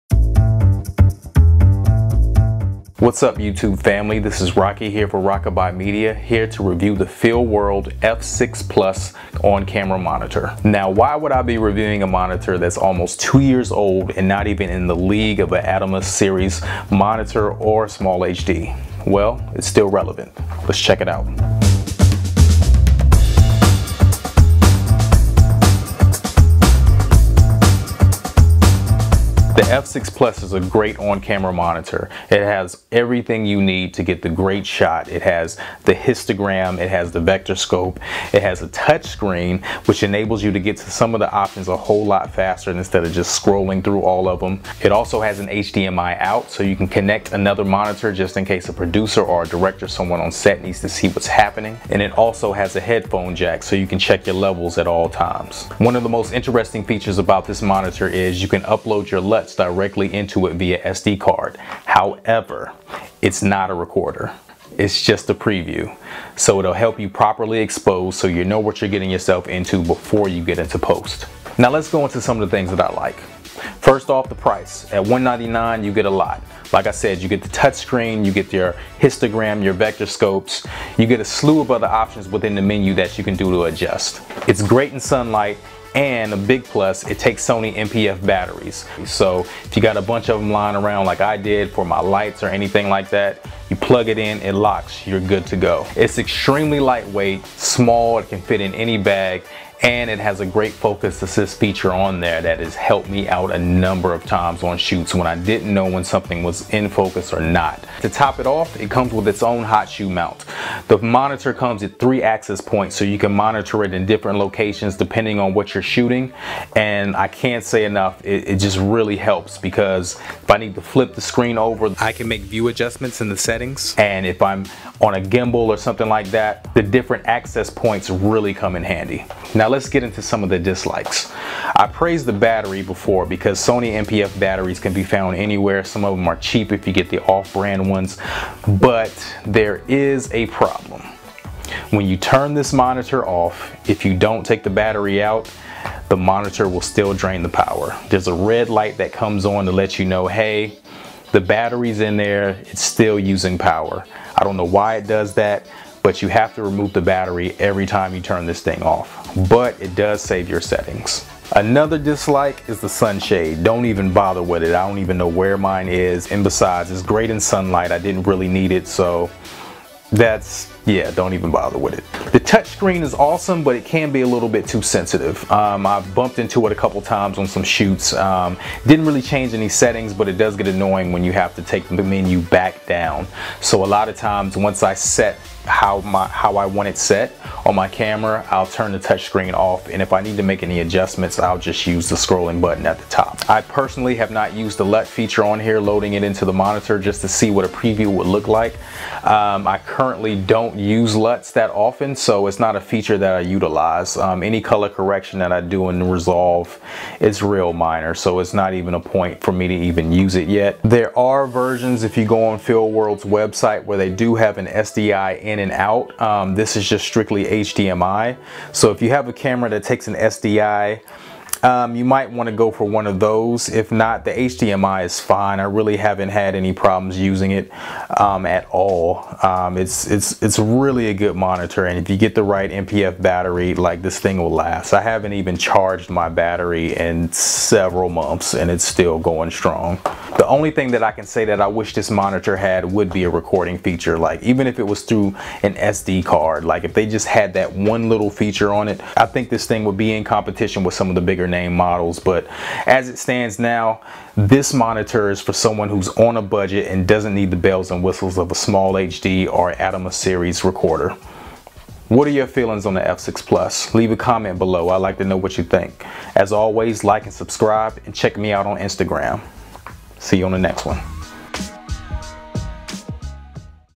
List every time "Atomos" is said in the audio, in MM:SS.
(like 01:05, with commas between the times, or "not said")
00:15, 04:19.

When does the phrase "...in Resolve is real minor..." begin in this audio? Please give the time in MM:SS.
03:25.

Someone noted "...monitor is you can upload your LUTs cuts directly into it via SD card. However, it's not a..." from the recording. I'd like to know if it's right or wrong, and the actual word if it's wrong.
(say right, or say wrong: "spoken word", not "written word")
right.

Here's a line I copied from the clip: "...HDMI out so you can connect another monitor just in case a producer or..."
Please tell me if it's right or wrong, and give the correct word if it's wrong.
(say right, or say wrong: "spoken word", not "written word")
right.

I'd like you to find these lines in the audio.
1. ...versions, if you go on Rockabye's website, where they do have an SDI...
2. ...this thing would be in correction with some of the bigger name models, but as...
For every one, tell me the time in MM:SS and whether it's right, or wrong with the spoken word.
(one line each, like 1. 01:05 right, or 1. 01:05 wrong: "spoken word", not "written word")
1. 03:31 wrong: "World", not "Rockabye"
2. 04:09 wrong: "competition", not "correction".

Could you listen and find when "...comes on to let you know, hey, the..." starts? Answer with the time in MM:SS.
02:29.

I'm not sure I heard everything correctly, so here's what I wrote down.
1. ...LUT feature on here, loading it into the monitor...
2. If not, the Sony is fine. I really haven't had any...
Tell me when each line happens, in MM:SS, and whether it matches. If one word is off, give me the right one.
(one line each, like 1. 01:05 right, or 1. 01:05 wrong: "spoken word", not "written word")
1. 03:14 right
2. 03:43 wrong: "HDMI", not "Sony".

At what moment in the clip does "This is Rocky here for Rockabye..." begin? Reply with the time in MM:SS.
00:04.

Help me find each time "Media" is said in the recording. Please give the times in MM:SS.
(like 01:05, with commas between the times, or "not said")
00:05.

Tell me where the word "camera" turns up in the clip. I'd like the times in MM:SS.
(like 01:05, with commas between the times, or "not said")
00:09, 00:30, 03:07, 03:39.